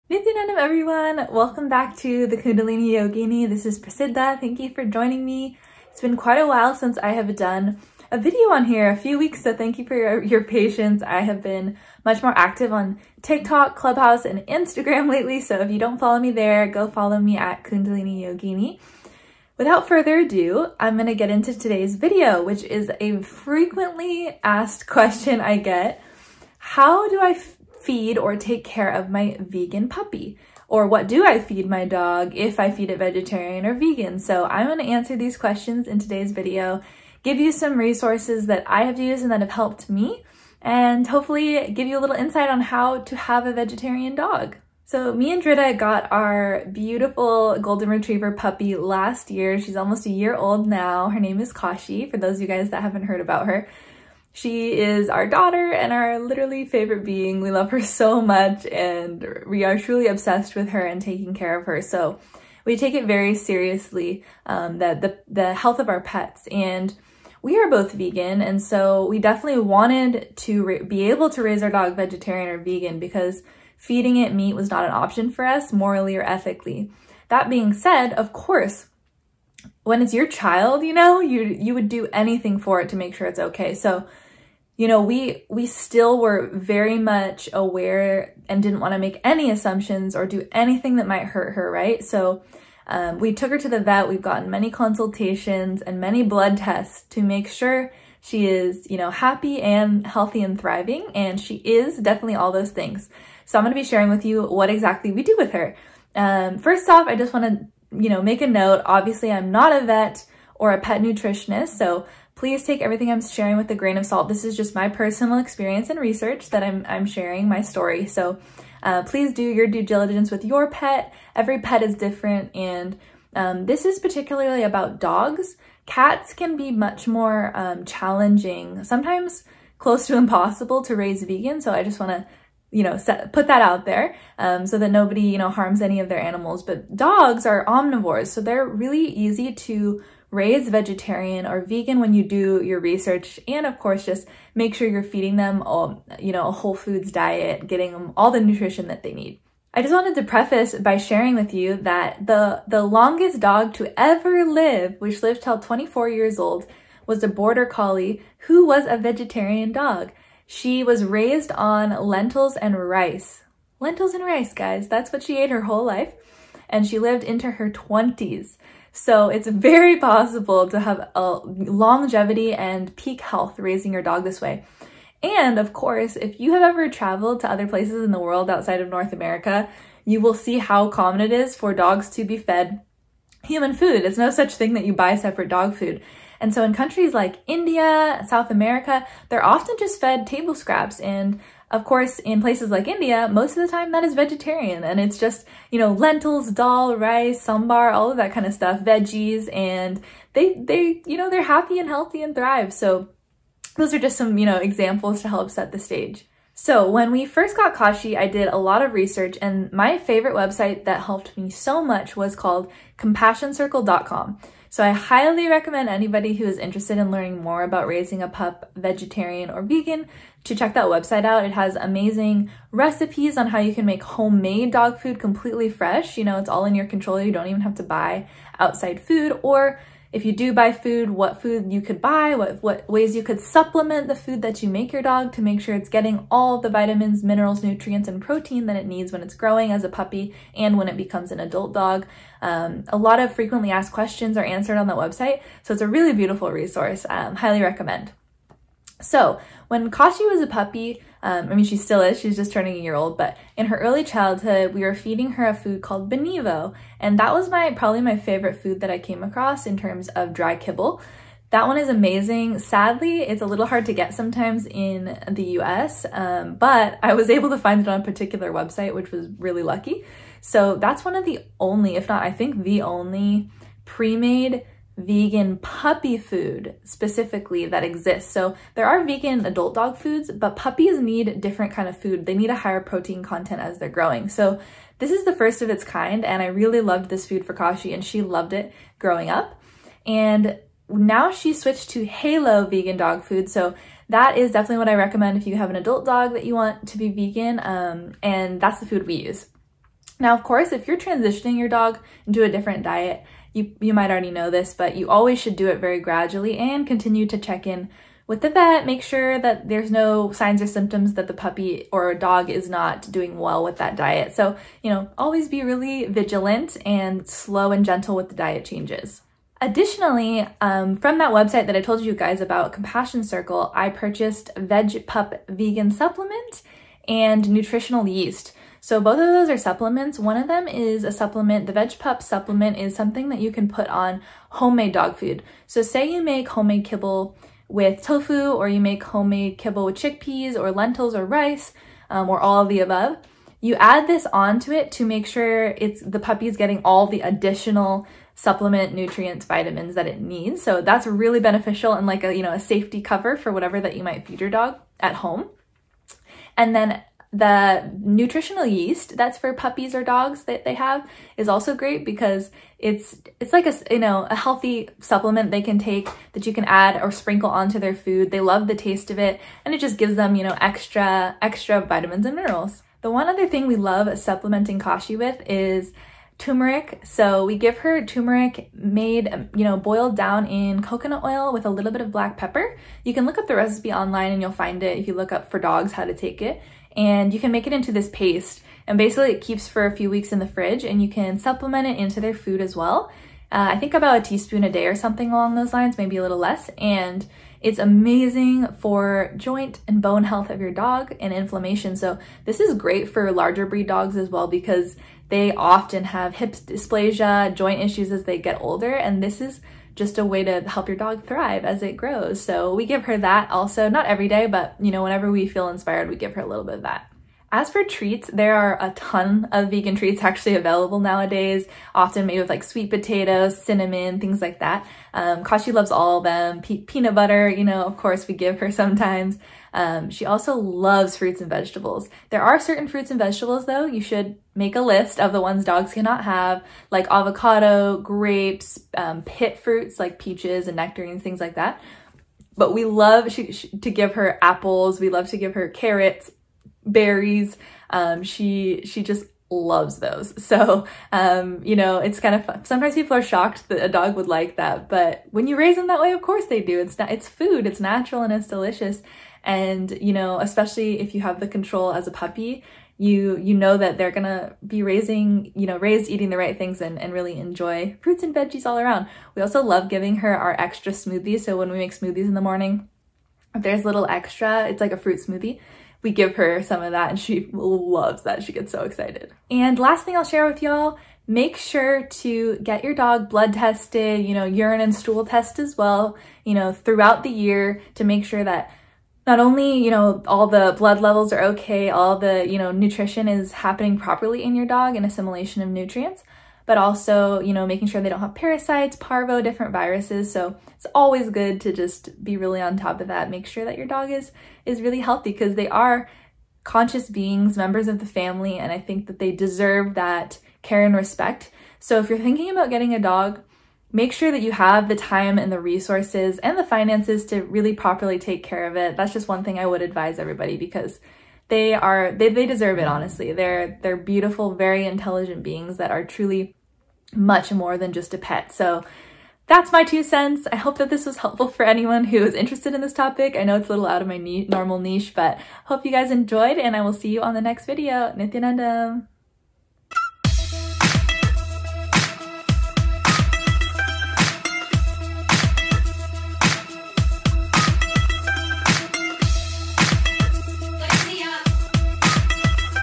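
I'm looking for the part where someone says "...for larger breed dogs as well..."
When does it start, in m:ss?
6:43.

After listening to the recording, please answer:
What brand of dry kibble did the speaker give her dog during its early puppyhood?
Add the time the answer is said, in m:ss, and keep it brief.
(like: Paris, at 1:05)
Benevo, at 4:16.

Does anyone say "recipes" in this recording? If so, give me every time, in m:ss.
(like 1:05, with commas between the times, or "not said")
3:42, 6:23.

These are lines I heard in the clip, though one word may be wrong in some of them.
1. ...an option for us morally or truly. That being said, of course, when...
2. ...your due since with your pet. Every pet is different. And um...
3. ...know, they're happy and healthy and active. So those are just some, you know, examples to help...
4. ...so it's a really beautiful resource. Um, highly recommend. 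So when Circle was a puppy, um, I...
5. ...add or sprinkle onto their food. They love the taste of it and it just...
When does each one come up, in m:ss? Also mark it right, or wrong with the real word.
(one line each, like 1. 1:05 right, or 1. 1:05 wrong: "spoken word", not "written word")
1. 1:14 wrong: "ethically", not "truly"
2. 1:59 wrong: "diligence", not "since"
3. 3:21 wrong: "thrive", not "active"
4. 4:05 wrong: "Kashi", not "Circle"
5. 6:06 right.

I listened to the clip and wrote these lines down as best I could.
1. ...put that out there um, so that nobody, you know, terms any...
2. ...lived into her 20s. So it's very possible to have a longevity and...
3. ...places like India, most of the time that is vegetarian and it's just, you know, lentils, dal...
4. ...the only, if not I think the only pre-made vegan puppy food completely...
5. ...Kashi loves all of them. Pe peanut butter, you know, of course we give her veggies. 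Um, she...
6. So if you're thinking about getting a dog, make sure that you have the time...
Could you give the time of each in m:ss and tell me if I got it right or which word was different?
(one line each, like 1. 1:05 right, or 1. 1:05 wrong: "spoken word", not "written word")
1. 2:13 wrong: "harms", not "terms"
2. 2:46 right
3. 3:12 right
4. 4:31 wrong: "specifically", not "completely"
5. 7:05 wrong: "sometimes", not "veggies"
6. 8:31 right.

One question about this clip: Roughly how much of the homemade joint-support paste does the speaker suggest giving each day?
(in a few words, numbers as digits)
About a teaspoon.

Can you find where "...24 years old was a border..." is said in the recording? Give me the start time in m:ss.
2:35.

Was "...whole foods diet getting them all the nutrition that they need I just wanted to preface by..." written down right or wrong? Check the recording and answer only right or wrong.
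right.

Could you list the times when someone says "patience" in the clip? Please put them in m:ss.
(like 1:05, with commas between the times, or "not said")
0:10.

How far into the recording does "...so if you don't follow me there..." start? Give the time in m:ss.
0:15.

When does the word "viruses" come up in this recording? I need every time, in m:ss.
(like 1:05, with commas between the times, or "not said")
8:19.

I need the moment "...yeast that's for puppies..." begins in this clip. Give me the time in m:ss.
5:58.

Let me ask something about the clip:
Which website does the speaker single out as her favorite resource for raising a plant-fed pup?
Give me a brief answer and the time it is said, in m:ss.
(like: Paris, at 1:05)
compassioncircle.com, at 3:32.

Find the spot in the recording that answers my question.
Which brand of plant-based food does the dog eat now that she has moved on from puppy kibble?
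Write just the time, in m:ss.
4:52.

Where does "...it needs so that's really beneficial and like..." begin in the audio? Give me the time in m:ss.
5:50.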